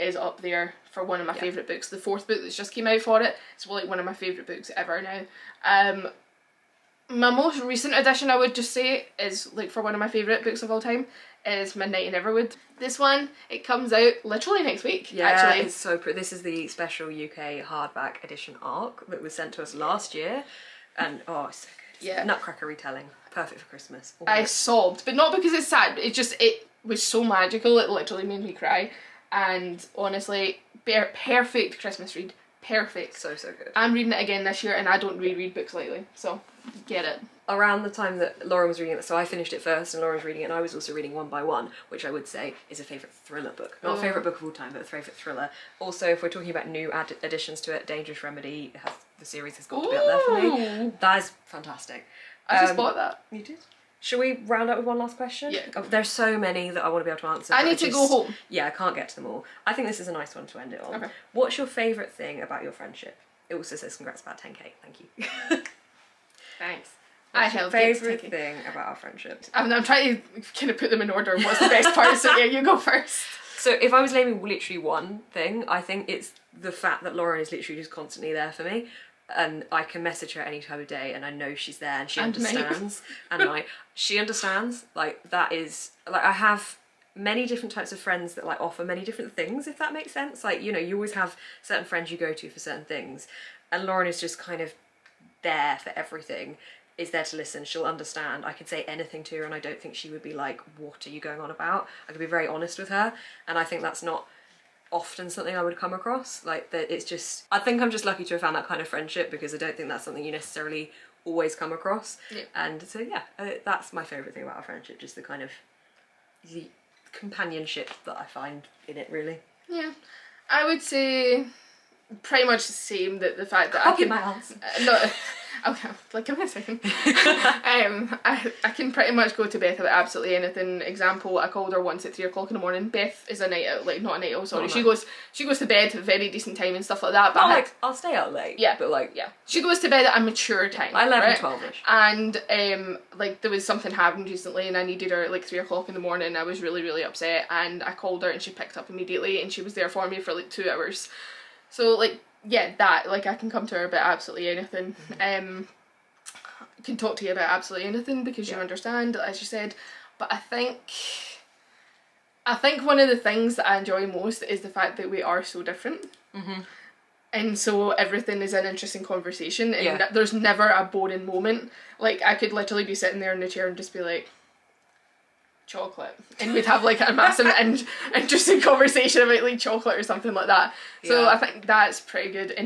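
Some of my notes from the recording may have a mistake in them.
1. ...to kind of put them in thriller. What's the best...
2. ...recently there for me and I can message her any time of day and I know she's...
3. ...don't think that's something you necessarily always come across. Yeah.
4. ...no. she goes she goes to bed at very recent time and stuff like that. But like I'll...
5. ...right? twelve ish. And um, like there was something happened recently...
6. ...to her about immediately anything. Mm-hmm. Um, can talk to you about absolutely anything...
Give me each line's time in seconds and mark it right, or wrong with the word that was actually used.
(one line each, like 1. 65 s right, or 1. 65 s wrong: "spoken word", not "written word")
1. 70 s wrong: "order", not "thriller"
2. 77 s wrong: "constantly", not "recently"
3. 109 s right
4. 134 s wrong: "decent", not "recent"
5. 141 s right
6. 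153 s wrong: "absolutely", not "immediately".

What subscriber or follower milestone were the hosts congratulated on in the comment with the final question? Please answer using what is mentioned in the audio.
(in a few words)
10k.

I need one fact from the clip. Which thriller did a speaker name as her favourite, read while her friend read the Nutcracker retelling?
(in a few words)
One by One.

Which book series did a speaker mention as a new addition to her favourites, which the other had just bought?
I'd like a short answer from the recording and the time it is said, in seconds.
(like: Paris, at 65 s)
Dangerous Remedy, at 47 s.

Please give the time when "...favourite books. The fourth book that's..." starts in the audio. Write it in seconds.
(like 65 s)
1 s.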